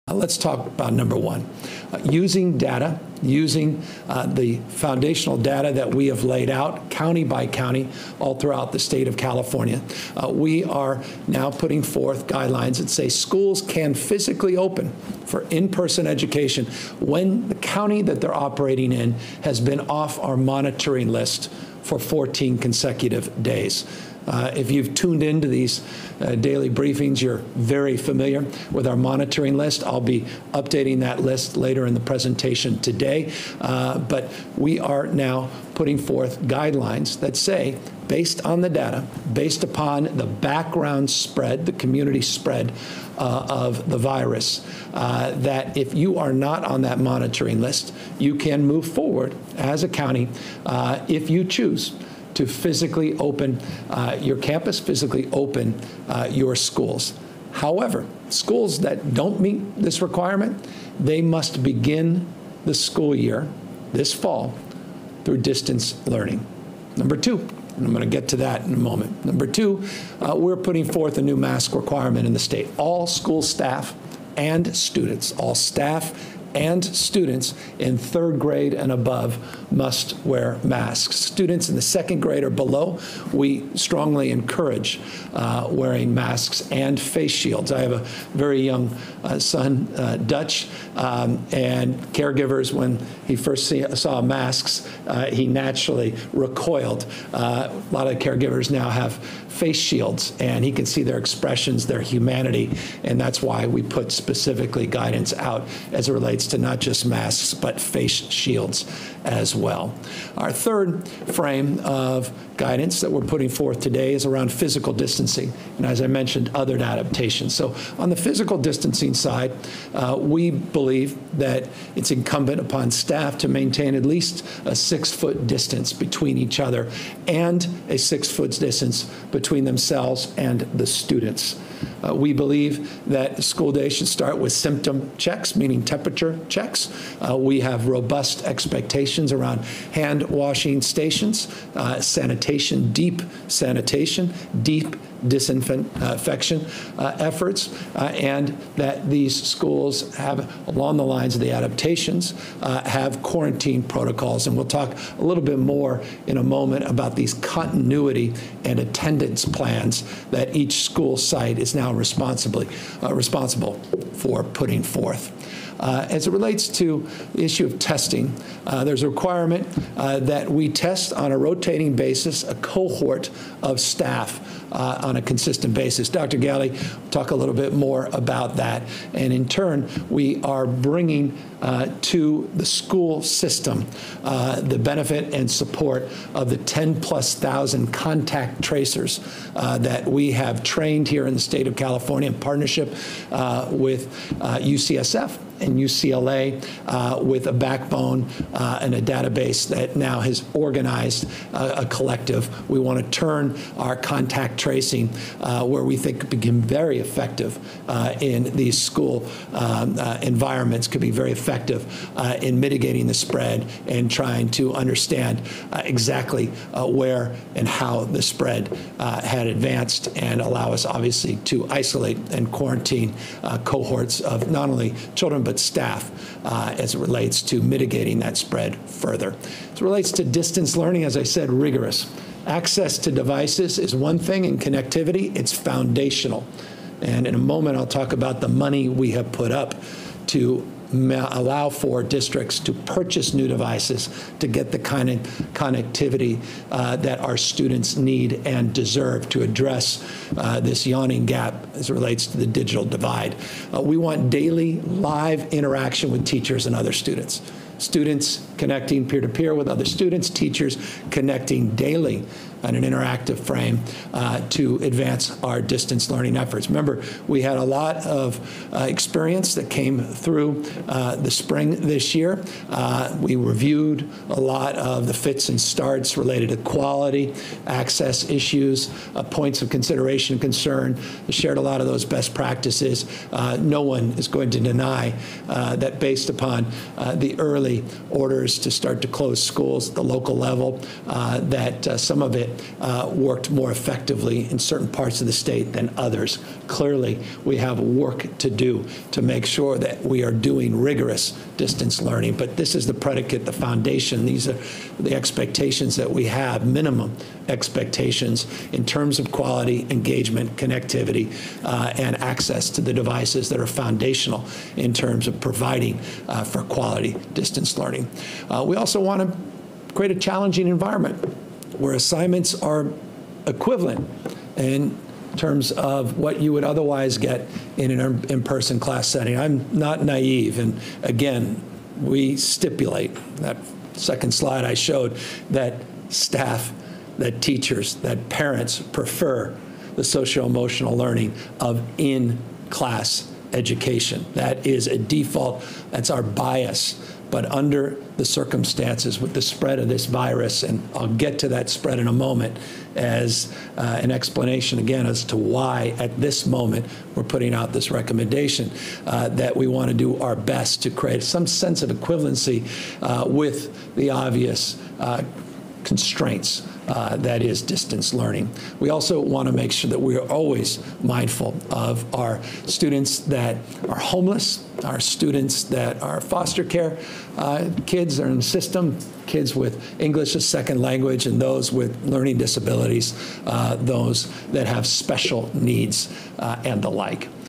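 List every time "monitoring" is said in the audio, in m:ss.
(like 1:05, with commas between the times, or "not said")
0:20, 0:28, 0:46.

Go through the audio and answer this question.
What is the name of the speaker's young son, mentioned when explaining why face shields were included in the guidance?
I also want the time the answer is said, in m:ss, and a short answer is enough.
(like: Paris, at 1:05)
Dutch, at 1:30.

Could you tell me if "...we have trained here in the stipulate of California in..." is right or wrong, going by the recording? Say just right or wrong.
wrong.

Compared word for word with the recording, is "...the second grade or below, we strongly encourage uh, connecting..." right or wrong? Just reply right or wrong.
wrong.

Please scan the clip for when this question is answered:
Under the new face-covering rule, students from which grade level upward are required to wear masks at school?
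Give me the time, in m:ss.
1:17.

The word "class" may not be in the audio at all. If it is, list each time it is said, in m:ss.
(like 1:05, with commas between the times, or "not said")
5:28, 5:41.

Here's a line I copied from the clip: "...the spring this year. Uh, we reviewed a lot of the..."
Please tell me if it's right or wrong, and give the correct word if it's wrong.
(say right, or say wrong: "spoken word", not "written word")
right.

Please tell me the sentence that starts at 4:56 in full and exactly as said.
Clearly, we have work to do to make sure that we are doing rigorous distance learning.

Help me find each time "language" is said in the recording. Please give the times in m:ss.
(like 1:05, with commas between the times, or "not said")
6:20.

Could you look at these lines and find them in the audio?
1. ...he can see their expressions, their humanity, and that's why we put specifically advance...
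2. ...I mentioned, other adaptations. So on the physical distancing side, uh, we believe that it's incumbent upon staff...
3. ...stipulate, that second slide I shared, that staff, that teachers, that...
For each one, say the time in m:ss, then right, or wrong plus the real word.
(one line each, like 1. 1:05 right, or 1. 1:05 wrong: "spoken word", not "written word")
1. 1:40 wrong: "guidance", not "advance"
2. 1:56 right
3. 5:32 wrong: "showed", not "shared".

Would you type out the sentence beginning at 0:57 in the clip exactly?
However, schools that don't meet this requirement, they must begin the school year this fall through distance learning.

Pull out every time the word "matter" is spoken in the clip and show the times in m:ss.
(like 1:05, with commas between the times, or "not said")
not said.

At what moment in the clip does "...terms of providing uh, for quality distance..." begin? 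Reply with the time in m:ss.
5:14.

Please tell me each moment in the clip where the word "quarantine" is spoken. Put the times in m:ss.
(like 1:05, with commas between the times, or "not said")
2:33, 3:42.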